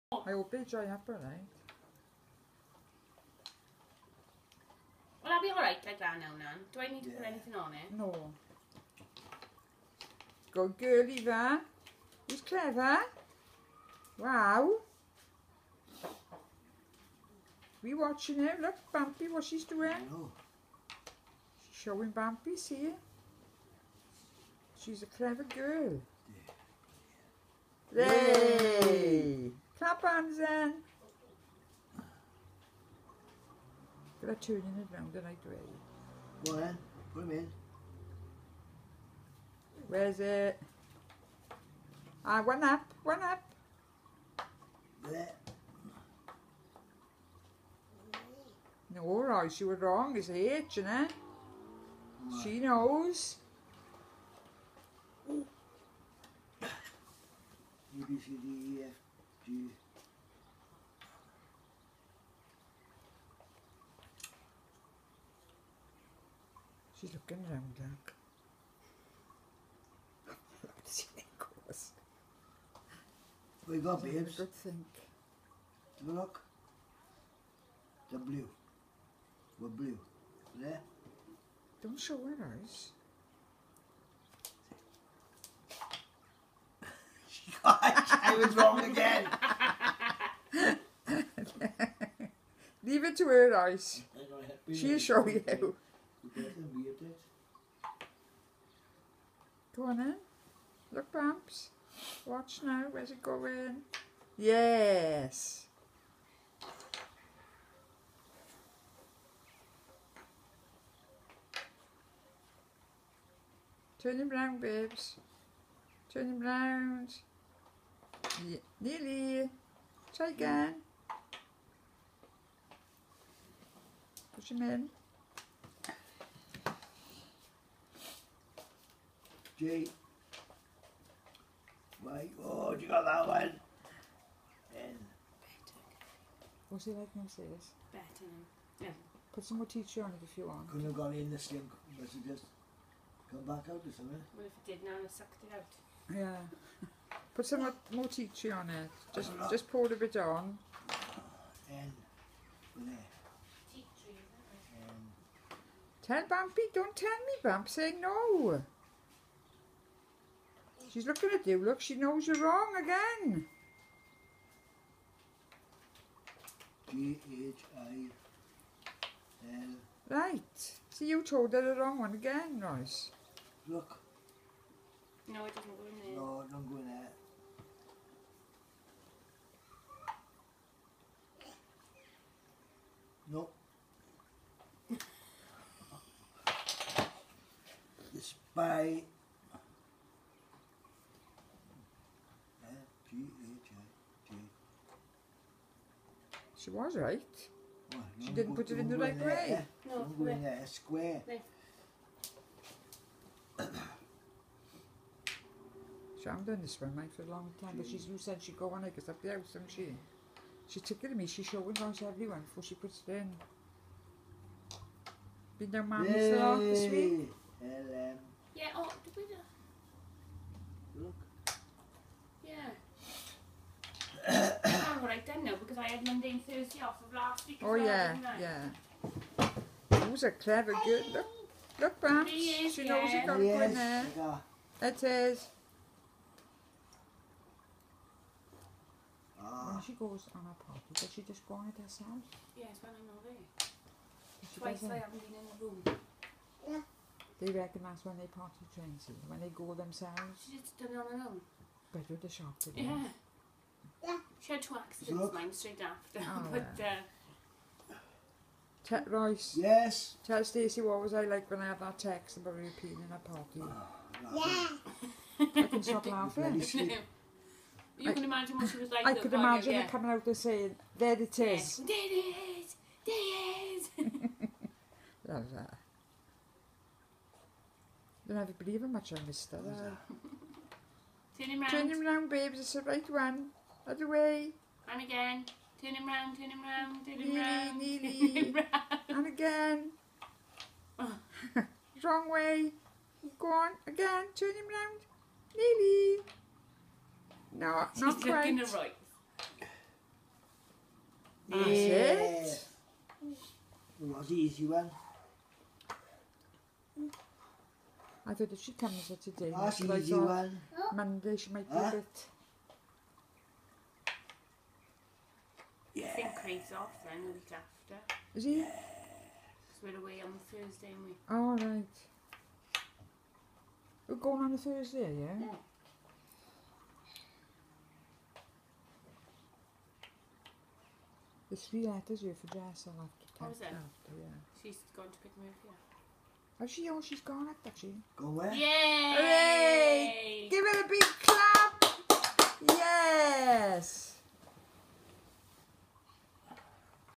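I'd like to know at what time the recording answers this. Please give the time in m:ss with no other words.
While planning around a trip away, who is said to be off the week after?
5:16.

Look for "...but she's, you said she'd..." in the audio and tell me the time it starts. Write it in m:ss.
3:27.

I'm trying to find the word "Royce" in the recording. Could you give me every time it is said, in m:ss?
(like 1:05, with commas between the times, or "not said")
2:52, 4:19.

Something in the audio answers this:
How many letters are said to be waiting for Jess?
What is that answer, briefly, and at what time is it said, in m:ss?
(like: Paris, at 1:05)
3, at 5:31.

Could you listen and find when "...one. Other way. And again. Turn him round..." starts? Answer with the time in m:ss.
4:43.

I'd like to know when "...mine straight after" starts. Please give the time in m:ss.
4:15.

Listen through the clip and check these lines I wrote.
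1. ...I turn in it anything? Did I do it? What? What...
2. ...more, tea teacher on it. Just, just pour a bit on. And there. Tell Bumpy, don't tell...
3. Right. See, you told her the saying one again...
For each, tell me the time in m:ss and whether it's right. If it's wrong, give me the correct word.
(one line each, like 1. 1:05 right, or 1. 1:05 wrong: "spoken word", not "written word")
1. 0:34 wrong: "wrong", not "anything"
2. 2:27 right
3. 2:50 wrong: "wrong", not "saying".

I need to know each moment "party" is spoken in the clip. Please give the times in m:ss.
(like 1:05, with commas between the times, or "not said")
4:00, 4:08, 4:23.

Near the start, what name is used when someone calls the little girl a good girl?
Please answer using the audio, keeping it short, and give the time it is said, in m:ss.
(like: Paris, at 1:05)
Eva, at 0:11.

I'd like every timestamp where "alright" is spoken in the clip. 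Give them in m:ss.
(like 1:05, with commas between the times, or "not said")
0:01, 0:05.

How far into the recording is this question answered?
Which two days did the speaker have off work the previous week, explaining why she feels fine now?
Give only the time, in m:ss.
3:46.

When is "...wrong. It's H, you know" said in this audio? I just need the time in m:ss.
0:49.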